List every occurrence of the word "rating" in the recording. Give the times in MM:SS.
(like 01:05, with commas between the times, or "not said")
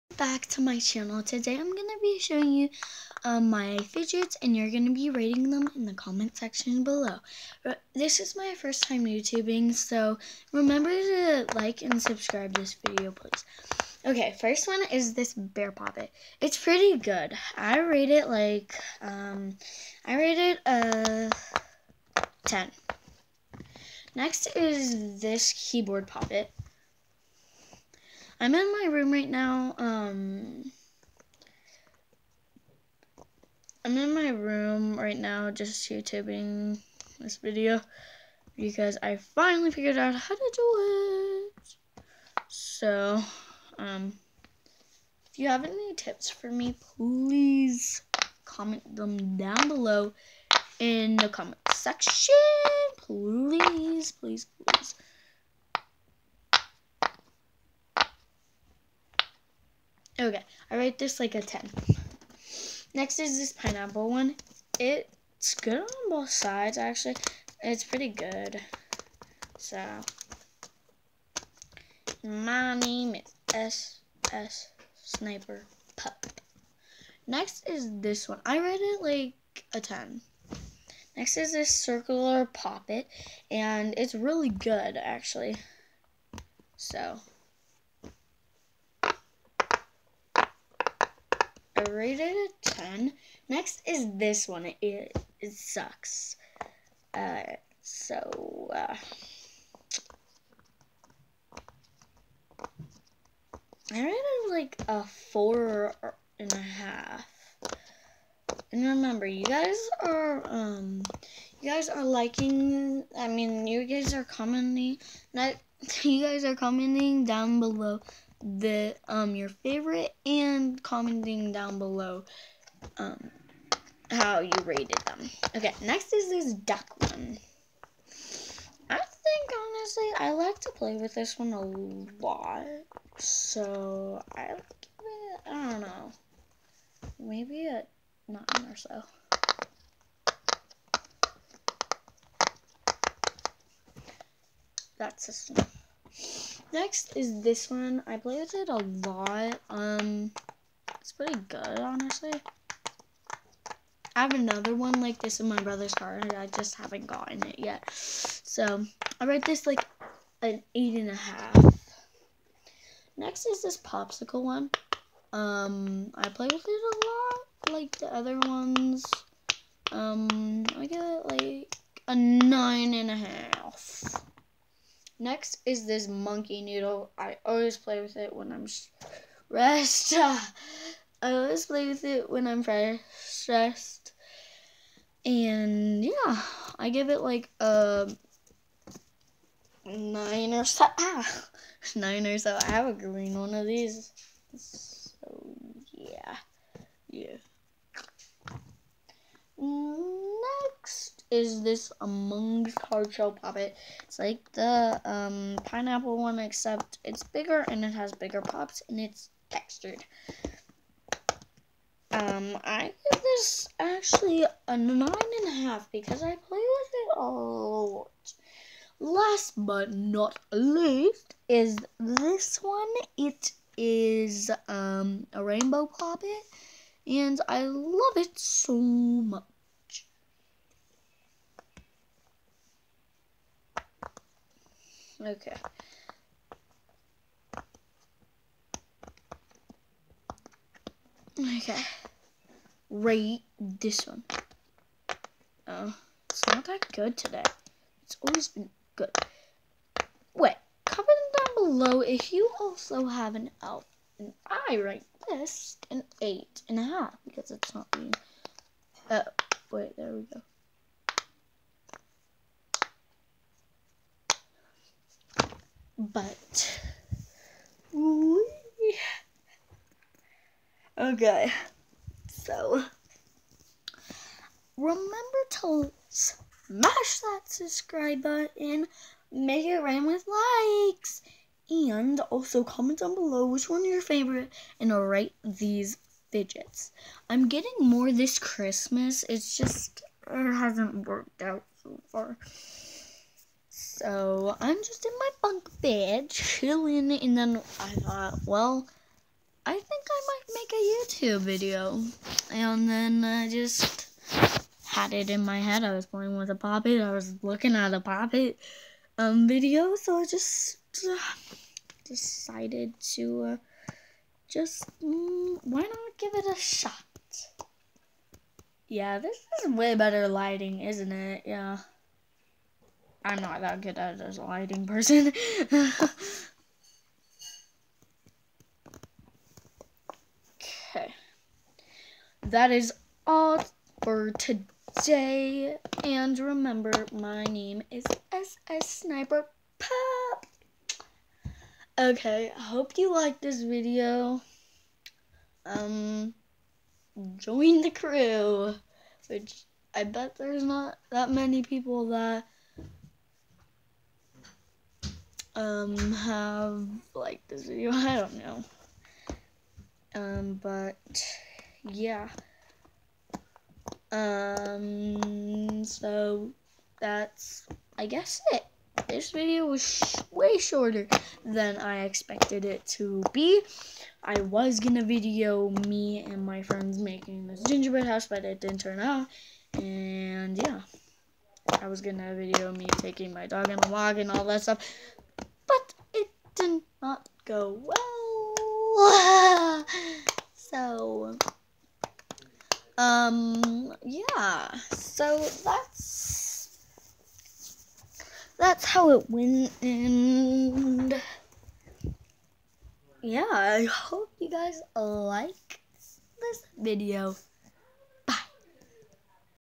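00:05.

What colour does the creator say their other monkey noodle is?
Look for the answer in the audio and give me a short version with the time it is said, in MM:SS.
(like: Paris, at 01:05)
green, at 03:12.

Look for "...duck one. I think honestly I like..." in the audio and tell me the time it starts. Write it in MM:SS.
02:06.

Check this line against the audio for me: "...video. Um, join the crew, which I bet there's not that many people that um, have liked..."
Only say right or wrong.
right.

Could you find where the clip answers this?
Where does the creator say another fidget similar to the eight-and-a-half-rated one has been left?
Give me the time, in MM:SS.
02:35.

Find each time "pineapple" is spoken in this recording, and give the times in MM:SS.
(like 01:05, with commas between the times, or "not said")
01:03, 03:25.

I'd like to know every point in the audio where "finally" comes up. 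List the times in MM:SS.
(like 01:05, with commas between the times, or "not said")
00:39.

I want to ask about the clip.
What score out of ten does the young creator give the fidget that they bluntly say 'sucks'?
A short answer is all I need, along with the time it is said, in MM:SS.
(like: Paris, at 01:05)
4.5, at 01:45.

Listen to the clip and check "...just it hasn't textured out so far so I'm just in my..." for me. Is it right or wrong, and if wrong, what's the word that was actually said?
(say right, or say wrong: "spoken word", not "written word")
wrong: "worked", not "textured".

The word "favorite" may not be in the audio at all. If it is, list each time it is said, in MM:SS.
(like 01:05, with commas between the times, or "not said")
01:59, 04:44.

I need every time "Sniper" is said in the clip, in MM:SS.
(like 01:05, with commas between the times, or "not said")
01:15, 05:38.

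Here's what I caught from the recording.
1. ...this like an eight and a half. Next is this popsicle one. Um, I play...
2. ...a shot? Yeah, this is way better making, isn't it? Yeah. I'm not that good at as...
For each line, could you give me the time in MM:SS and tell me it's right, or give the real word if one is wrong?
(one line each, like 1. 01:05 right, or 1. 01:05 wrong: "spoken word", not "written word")
1. 02:39 right
2. 05:16 wrong: "lighting", not "making".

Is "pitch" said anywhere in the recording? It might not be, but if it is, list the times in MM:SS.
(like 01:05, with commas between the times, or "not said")
not said.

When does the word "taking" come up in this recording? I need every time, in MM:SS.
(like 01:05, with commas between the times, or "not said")
06:22.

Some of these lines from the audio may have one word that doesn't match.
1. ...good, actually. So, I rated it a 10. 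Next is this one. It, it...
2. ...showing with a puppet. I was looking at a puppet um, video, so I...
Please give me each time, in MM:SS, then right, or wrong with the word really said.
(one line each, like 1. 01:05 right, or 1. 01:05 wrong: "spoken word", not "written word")
1. 01:24 right
2. 05:06 wrong: "playing", not "showing".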